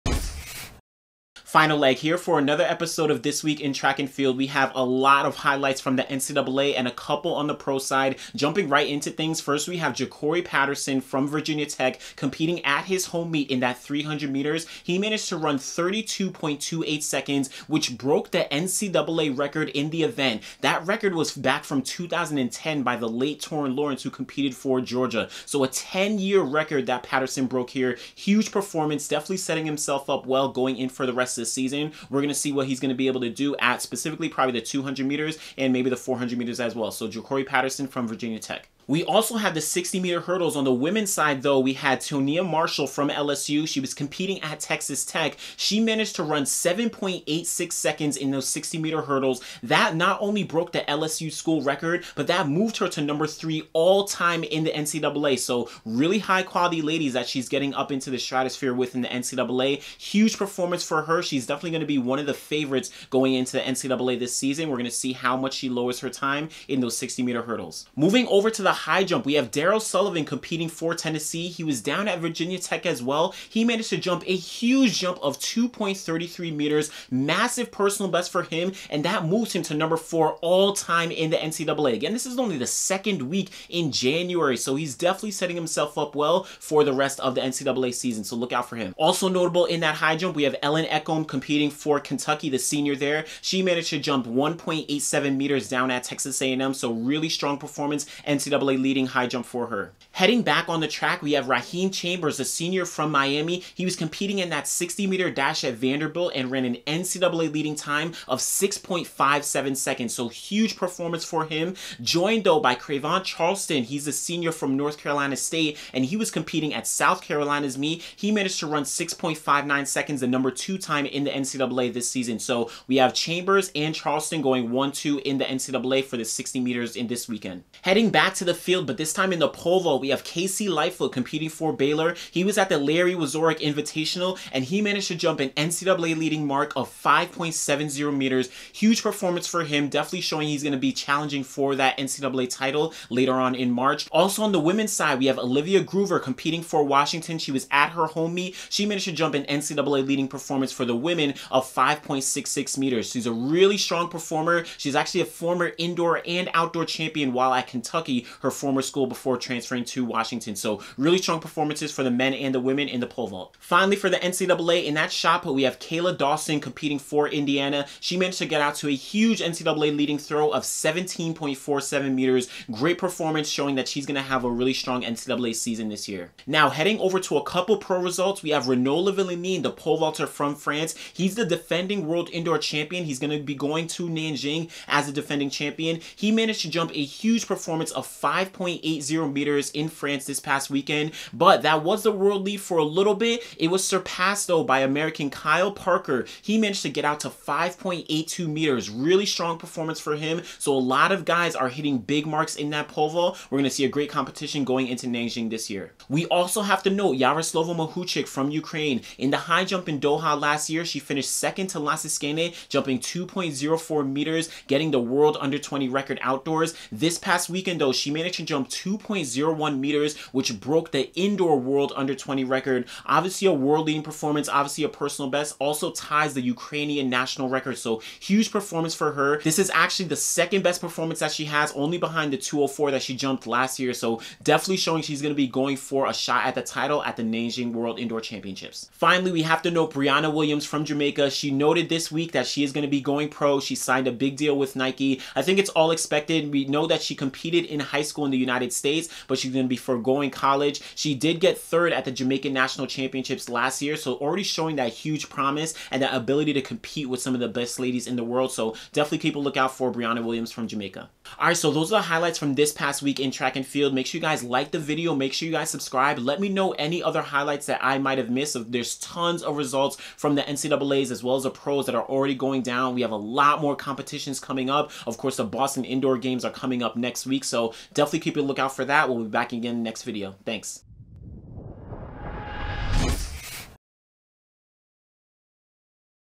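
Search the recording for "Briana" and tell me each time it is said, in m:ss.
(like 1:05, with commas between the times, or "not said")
3:59, 4:19.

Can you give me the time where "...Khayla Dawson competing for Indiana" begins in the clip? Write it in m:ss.
2:45.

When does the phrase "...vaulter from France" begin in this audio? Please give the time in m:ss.
2:59.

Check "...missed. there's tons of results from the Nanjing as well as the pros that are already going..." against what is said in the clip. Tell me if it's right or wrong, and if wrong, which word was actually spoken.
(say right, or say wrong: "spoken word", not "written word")
wrong: "NCAAs", not "Nanjing".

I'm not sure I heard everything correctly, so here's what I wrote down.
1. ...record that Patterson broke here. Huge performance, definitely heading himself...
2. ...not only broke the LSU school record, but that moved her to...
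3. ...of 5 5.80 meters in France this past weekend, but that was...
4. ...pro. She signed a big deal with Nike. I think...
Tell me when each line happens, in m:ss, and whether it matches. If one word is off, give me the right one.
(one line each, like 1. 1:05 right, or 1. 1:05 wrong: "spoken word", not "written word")
1. 0:26 wrong: "setting", not "heading"
2. 0:49 right
3. 3:07 right
4. 4:03 right.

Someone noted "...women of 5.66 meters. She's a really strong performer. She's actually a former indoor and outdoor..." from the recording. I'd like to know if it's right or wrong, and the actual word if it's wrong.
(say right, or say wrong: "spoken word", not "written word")
right.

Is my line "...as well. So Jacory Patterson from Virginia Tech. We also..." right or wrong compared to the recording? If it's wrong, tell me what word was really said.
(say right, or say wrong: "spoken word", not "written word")
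right.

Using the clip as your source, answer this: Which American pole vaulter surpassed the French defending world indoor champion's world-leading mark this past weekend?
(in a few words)
Kyle Parker.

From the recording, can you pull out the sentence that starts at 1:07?
Moving over to the high jump, we have Darryl Sullyvan competing for Tennessee.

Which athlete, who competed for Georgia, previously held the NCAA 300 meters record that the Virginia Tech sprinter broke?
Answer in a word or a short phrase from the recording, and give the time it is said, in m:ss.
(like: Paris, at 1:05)
Torrin Lawrence, at 0:23.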